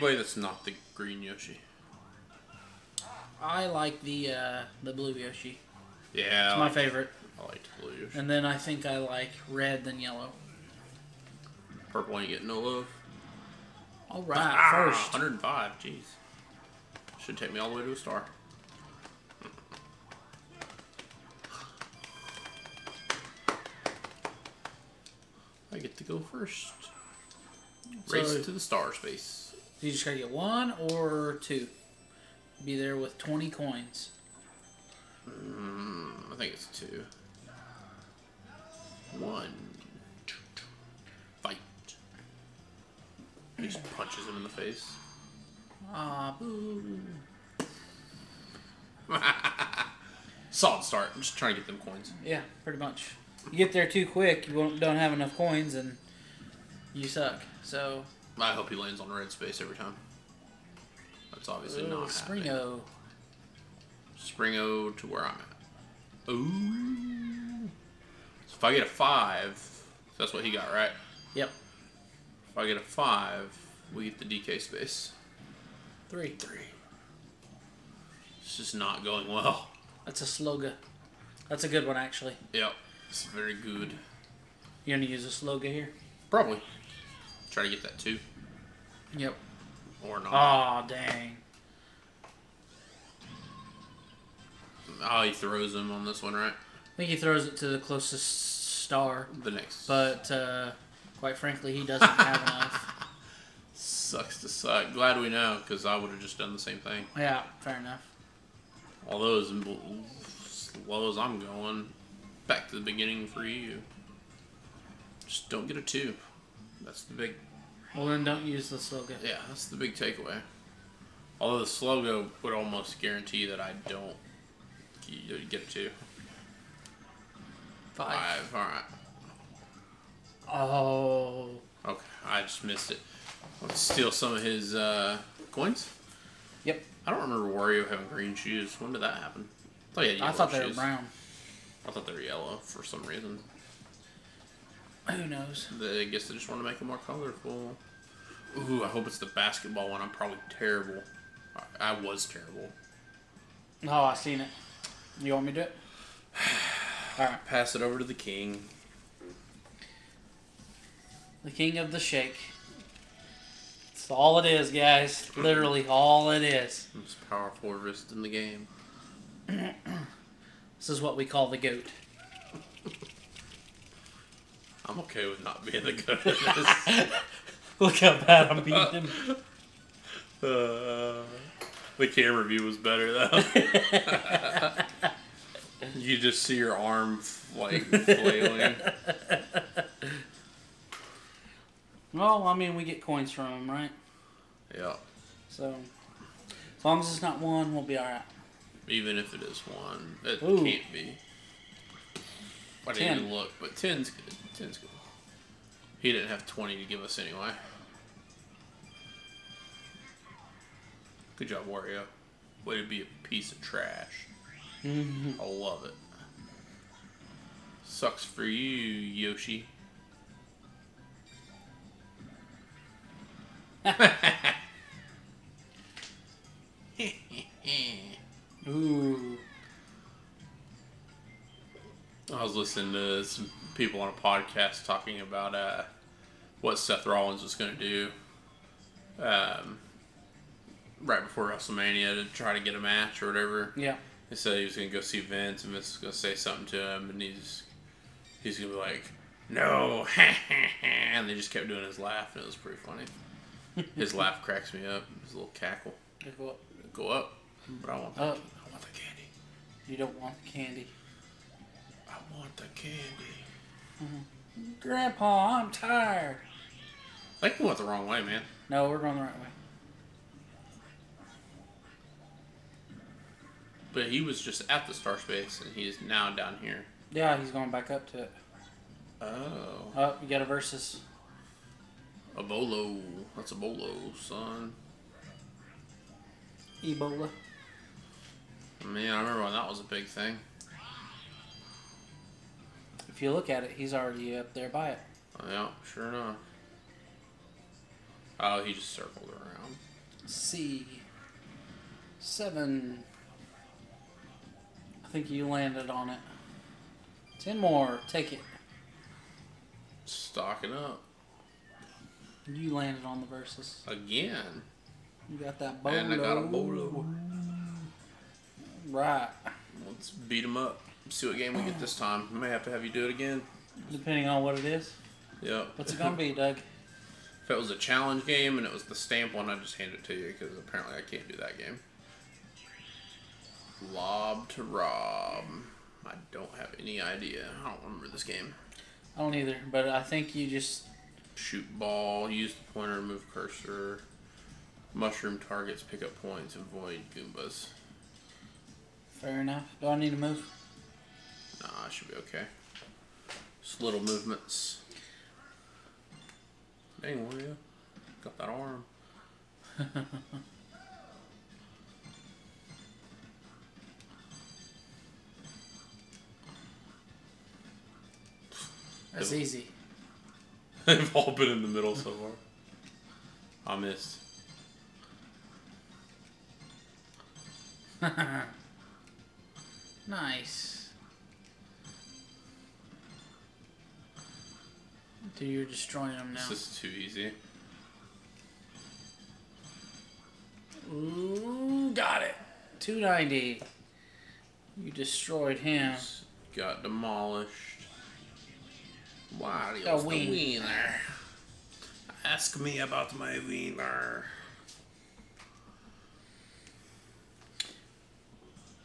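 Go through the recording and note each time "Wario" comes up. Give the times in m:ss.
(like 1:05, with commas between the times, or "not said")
2:17, 3:31.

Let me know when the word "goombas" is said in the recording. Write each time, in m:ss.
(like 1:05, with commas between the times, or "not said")
5:47.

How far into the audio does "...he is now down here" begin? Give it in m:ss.
4:35.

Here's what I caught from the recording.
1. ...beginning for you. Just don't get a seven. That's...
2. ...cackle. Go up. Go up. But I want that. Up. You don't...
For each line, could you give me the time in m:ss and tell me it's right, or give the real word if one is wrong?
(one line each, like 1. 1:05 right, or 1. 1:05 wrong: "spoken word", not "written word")
1. 1:52 wrong: "two", not "seven"
2. 4:15 right.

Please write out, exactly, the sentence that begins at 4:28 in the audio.
No, we're going the right way.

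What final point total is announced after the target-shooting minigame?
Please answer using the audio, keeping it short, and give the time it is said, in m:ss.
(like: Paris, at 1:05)
290, at 6:32.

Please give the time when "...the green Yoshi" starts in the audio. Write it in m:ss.
0:00.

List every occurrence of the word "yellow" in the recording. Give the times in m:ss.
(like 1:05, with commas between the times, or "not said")
0:09, 2:22.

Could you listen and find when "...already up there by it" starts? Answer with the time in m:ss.
4:53.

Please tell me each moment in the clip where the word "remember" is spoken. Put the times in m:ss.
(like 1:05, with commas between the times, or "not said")
2:17, 4:49, 5:37.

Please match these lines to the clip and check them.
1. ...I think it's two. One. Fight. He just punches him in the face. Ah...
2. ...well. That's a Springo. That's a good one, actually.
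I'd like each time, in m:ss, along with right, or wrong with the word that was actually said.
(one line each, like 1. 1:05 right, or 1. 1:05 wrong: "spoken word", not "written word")
1. 0:36 right
2. 1:19 wrong: "Slowgo", not "Springo".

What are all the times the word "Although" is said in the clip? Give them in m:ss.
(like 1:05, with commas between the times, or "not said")
1:49, 2:01.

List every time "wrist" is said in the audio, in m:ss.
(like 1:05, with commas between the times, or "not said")
2:47.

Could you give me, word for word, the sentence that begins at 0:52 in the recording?
Yeah, pretty much you get there too quick, you won't, don't have enough coins, and you suck.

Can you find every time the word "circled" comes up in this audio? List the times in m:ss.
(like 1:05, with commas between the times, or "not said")
4:58.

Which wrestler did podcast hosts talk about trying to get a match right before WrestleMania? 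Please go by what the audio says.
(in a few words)
Seth Rollins.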